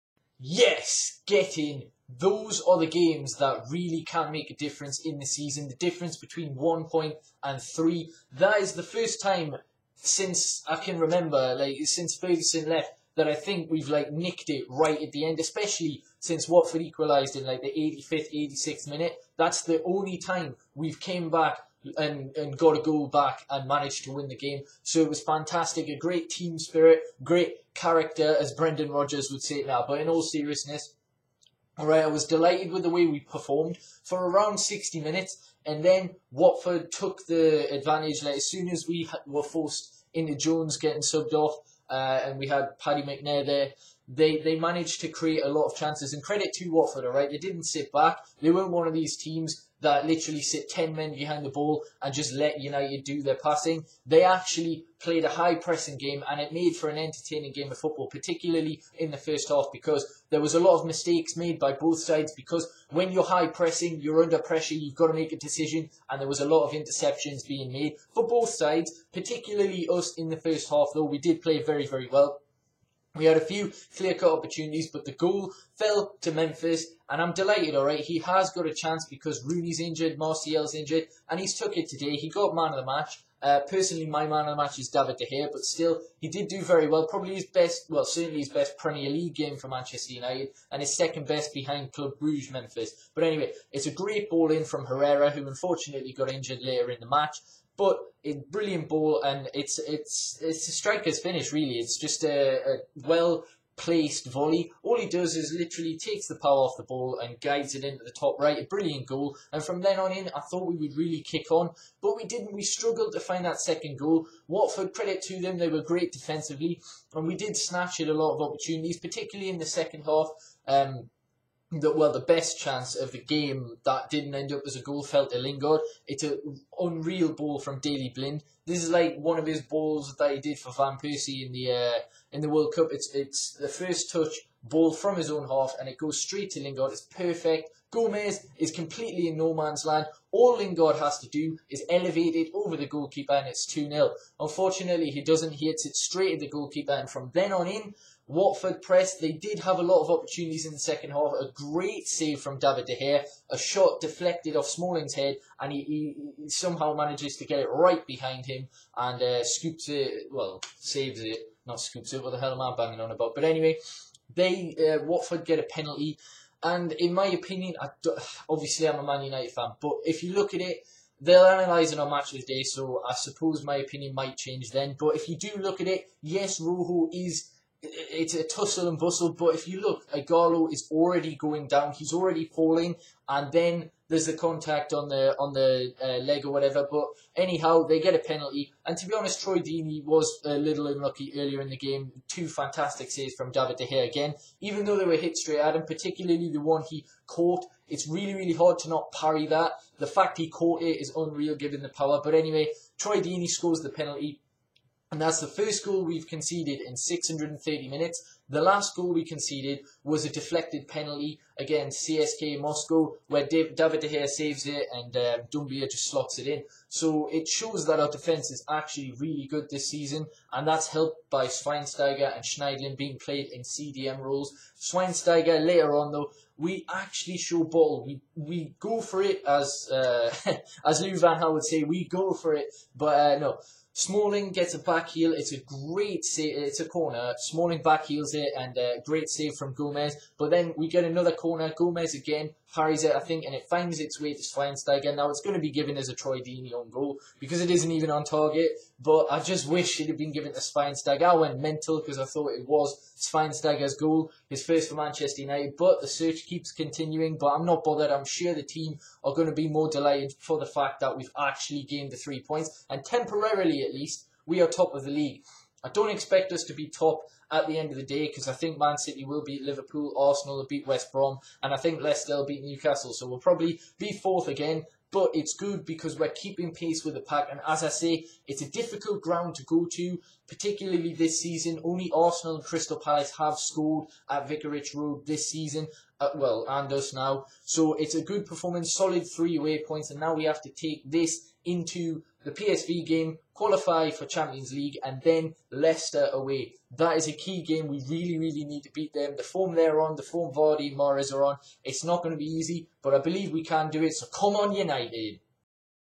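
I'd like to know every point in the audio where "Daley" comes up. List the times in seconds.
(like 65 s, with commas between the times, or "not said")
127 s.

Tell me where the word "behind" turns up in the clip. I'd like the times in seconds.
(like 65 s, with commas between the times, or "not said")
51 s, 91 s, 158 s.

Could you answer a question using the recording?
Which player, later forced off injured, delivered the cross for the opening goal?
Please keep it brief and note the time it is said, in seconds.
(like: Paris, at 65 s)
Herrera, at 94 s.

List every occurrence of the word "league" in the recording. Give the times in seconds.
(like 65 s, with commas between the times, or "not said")
89 s, 265 s, 294 s.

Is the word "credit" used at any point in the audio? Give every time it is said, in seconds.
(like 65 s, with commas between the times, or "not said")
46 s, 114 s.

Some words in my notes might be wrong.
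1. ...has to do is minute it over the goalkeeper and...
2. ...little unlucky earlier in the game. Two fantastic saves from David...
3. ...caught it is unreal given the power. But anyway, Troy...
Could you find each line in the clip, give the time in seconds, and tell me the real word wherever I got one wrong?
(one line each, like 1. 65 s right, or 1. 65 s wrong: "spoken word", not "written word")
1. 140 s wrong: "elevate", not "minute"
2. 190 s right
3. 200 s right.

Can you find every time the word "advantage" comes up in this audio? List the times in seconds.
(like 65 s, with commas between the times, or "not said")
37 s.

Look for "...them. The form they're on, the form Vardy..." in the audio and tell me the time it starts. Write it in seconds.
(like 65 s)
299 s.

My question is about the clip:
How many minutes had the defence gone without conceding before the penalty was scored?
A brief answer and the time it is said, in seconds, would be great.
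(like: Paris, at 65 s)
630, at 206 s.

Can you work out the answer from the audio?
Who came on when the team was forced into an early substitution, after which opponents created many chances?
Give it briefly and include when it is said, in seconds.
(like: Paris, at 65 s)
Paddy McNair, at 42 s.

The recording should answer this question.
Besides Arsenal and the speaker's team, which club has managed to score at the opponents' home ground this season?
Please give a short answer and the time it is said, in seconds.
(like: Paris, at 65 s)
Crystal Palace, at 282 s.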